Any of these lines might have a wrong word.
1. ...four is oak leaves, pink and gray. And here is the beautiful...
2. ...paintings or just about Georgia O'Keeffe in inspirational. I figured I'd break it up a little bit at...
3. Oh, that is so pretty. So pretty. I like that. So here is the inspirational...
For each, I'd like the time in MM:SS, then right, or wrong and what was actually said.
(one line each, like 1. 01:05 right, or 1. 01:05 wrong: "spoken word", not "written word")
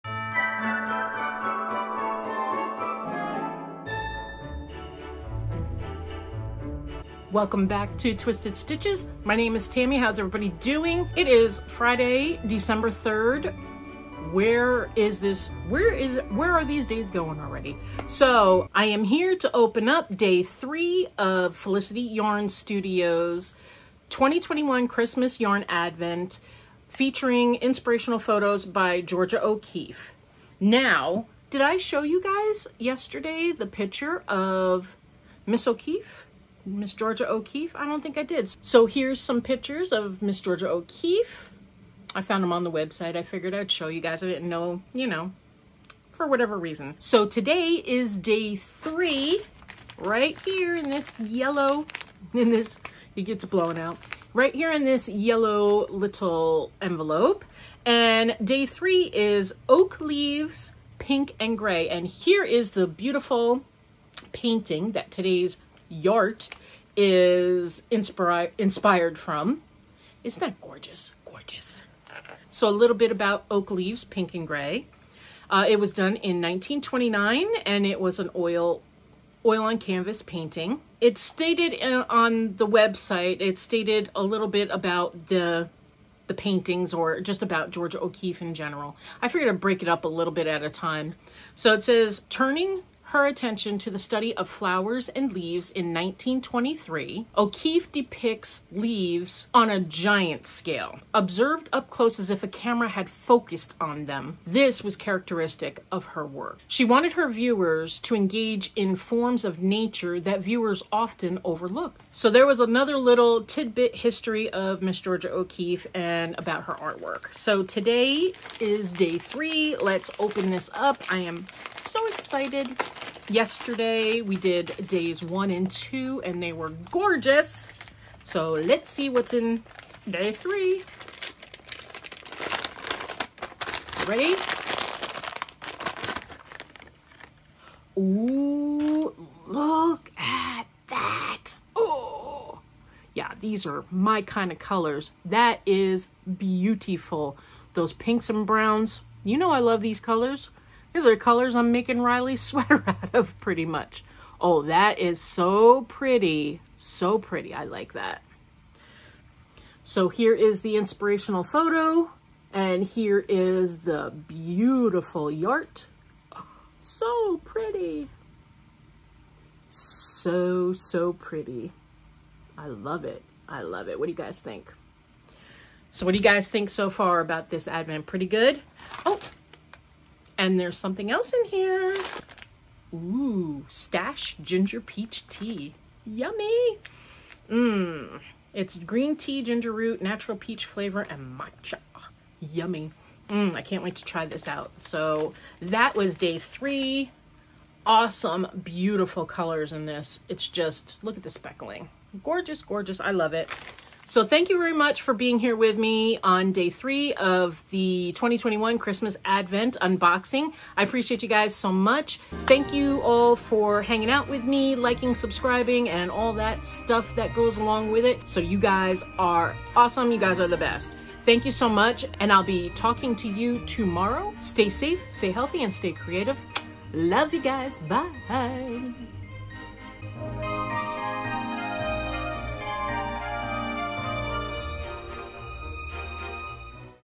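1. 00:58 wrong: "three", not "four"
2. 01:26 wrong: "general", not "inspirational"
3. 02:34 right.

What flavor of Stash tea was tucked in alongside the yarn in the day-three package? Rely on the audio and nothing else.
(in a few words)
Ginger Peach.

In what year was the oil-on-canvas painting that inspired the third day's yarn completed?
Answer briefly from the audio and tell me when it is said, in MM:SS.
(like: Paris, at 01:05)
1929, at 01:16.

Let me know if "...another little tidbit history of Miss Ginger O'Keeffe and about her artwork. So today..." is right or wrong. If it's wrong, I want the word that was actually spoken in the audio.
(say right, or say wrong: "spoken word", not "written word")
wrong: "Georgia", not "Ginger".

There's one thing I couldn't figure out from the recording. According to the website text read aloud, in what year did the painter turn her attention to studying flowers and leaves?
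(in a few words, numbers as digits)
1923.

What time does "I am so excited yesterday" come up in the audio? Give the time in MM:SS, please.
02:01.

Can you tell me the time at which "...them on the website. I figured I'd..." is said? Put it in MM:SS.
00:42.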